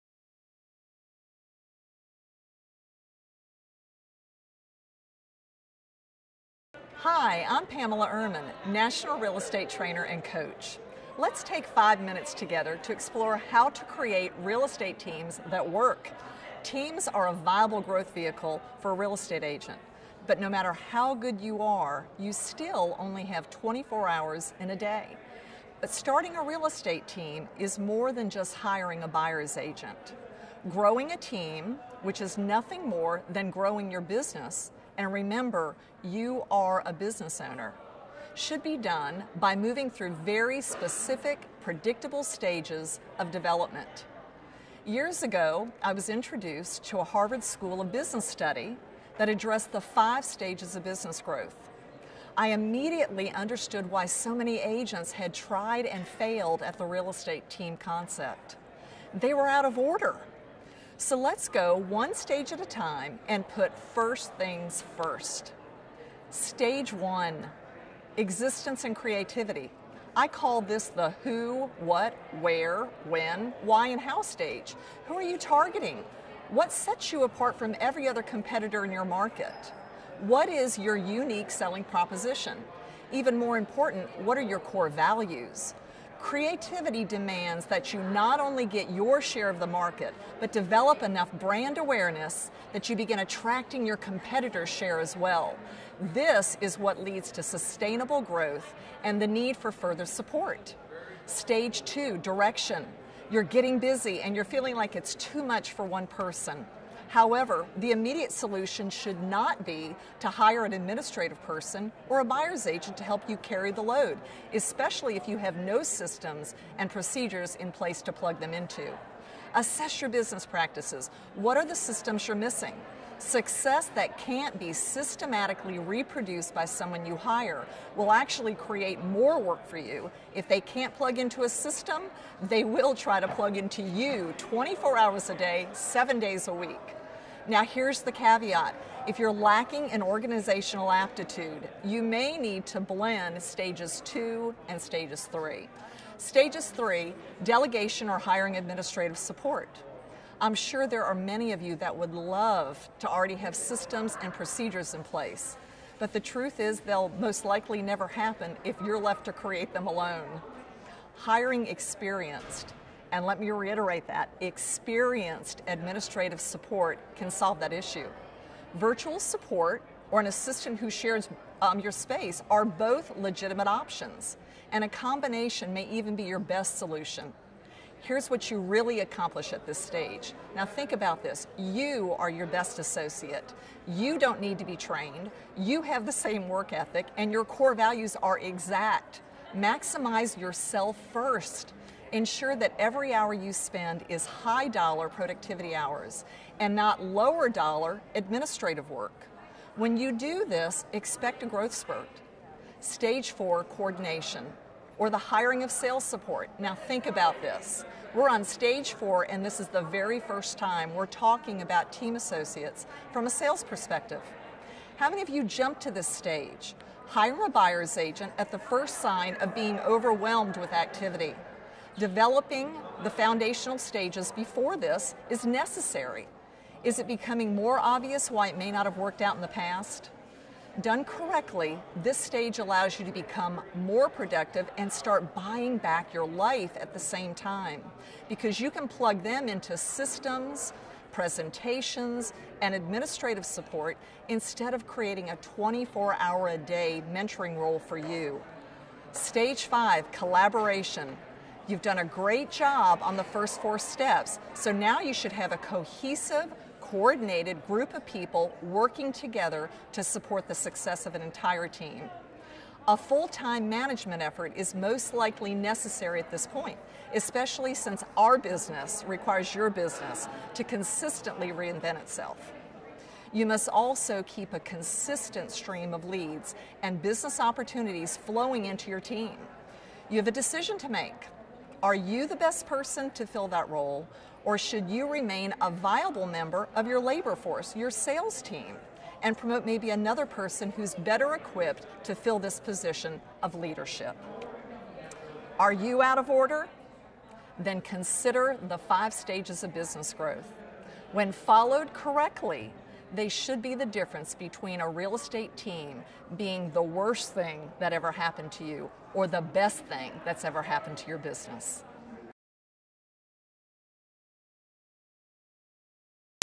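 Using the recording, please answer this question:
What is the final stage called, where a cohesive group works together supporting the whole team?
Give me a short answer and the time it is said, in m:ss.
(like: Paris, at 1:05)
Collaboration, at 4:10.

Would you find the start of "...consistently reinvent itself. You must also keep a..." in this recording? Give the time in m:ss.
4:30.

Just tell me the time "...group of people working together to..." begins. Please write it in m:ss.
4:17.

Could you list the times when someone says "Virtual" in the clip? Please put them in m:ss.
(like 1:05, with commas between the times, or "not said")
2:48.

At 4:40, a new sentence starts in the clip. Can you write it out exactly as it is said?
You have a decision to make.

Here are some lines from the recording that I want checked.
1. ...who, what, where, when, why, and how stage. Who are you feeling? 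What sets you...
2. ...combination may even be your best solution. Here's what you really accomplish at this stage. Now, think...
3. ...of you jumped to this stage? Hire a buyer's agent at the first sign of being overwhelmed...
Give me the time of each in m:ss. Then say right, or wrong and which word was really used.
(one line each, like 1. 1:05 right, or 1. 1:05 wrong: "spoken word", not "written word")
1. 1:11 wrong: "targeting", not "feeling"
2. 2:54 right
3. 3:35 right.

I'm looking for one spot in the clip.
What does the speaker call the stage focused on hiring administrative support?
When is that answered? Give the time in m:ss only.
2:27.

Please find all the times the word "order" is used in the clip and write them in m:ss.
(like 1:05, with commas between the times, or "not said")
0:59, 4:56.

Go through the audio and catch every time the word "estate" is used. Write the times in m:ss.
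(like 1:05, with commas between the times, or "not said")
0:09, 0:14, 0:19, 0:26, 0:57, 5:05.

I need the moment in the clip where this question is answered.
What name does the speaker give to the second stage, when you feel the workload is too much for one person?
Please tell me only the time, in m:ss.
1:42.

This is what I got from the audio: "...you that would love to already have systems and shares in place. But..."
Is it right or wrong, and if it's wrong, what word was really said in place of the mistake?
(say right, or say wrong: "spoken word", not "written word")
wrong: "procedures", not "shares".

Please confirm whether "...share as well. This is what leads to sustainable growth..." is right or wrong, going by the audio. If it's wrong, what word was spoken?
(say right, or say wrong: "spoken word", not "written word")
right.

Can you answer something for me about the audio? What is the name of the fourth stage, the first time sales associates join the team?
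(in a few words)
Coordination.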